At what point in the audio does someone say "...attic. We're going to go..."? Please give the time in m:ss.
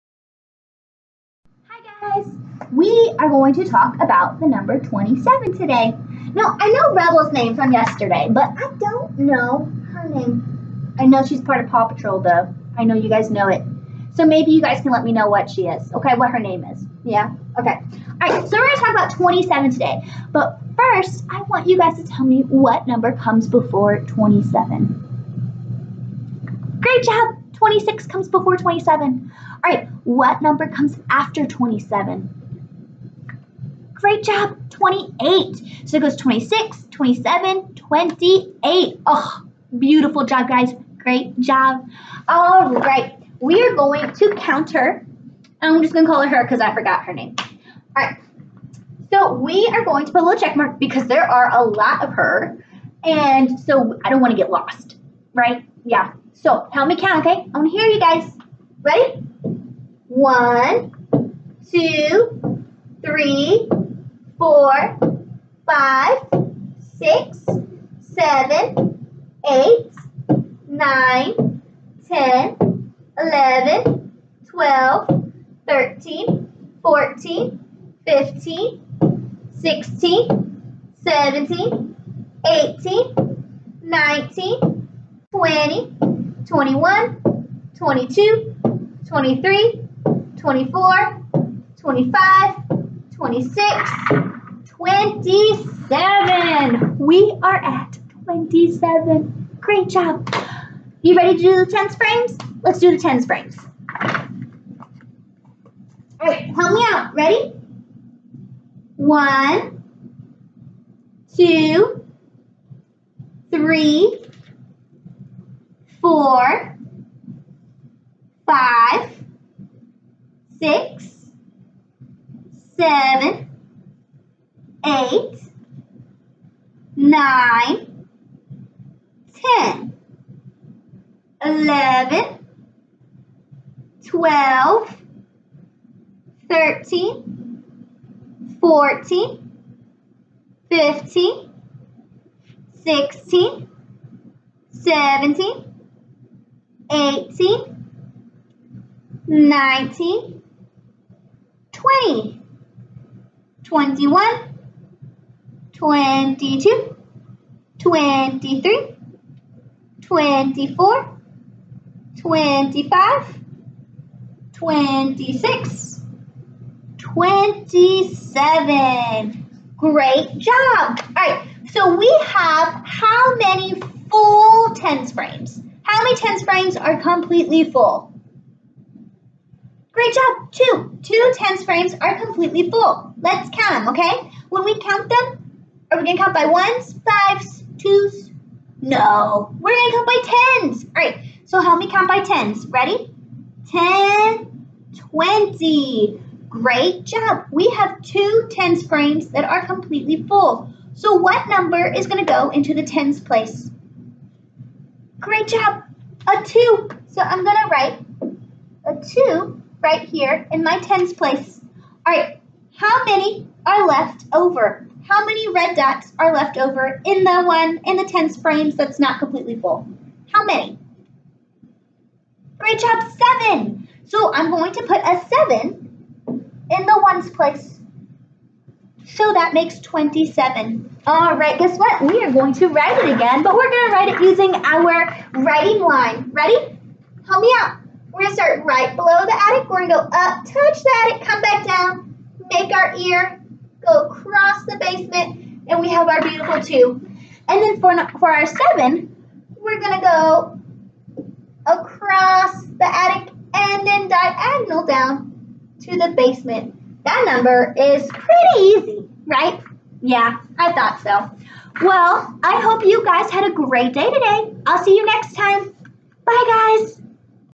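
3:59.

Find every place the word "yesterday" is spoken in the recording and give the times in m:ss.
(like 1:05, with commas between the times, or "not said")
0:07.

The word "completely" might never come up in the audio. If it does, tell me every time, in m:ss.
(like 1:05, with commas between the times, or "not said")
2:57, 3:02, 3:19, 3:39.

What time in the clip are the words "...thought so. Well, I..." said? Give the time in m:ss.
4:20.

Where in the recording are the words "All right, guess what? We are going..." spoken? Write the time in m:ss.
3:51.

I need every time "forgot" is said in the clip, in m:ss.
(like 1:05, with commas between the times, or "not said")
0:46.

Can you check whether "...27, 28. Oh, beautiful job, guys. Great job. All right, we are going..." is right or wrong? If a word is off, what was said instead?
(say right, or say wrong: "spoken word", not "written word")
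right.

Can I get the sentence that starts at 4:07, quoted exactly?
And then for, for our seven, we're going to go across the attic and then diagonal down to the basement.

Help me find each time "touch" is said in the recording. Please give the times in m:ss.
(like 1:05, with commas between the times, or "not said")
4:00.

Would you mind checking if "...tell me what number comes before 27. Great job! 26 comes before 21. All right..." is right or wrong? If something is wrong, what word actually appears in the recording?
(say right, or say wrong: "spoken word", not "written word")
wrong: "27", not "21".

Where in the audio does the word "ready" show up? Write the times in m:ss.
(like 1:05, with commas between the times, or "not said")
0:58, 1:41, 1:47, 3:12, 3:56.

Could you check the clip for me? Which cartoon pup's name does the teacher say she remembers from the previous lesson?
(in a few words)
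Rubble.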